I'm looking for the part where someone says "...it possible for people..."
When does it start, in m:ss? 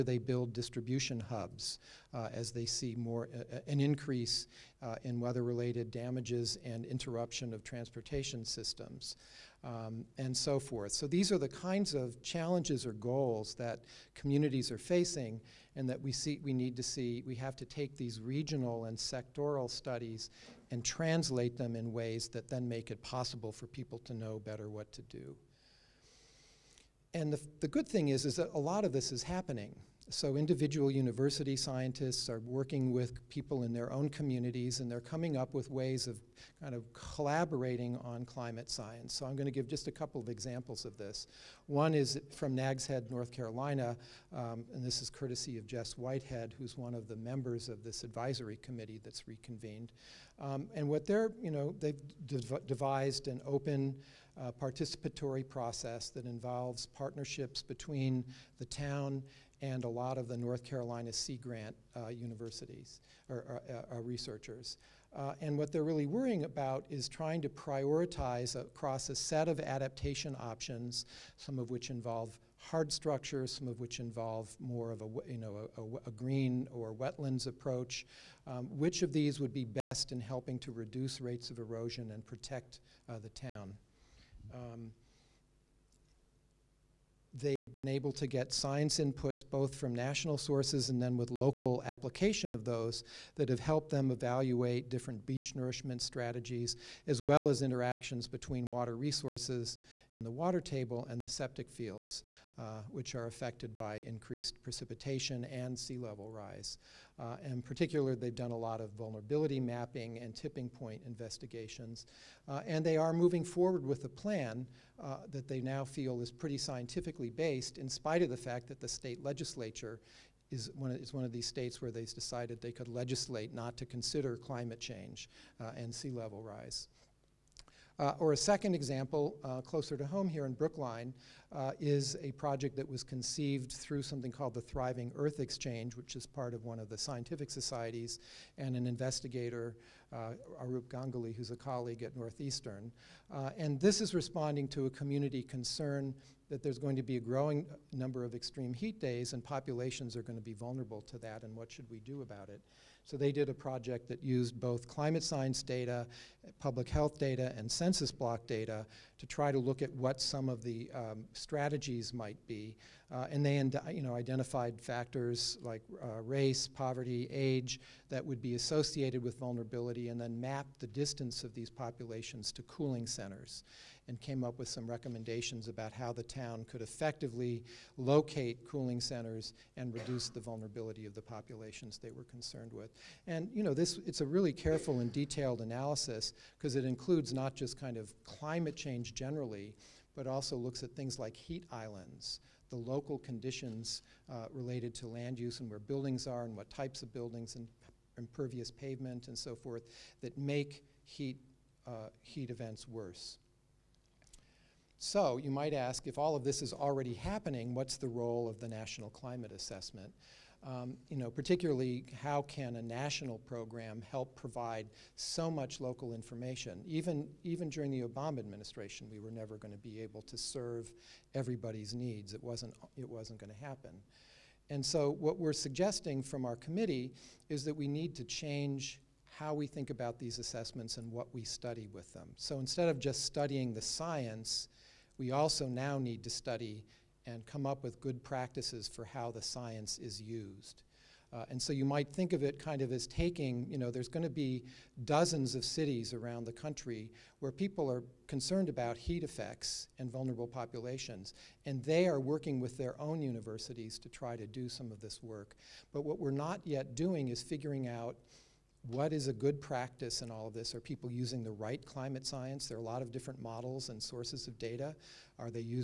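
0:22.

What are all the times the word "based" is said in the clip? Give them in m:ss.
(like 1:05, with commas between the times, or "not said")
1:57.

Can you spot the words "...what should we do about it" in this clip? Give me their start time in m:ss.
2:31.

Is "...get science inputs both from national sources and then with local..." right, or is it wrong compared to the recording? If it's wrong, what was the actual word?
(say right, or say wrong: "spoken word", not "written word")
right.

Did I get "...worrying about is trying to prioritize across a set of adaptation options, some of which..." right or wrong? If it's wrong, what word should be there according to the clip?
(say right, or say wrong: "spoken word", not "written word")
right.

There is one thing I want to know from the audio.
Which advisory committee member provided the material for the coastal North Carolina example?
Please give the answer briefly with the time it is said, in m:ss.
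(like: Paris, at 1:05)
Jess Whitehead, at 0:45.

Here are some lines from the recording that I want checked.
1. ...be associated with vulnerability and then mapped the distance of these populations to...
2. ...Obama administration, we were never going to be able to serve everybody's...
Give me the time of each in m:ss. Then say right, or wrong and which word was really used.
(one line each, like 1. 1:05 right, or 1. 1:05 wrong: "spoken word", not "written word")
1. 2:48 right
2. 3:38 right.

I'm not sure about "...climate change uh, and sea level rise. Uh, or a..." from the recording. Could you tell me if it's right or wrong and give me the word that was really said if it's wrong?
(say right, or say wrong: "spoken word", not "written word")
right.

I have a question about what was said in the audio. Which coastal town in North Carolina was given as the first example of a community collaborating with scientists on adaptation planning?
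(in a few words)
Nags Head.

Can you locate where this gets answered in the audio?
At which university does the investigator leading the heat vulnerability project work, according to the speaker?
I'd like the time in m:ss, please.
2:22.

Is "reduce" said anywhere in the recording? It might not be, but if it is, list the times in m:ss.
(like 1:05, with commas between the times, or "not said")
1:20, 2:59.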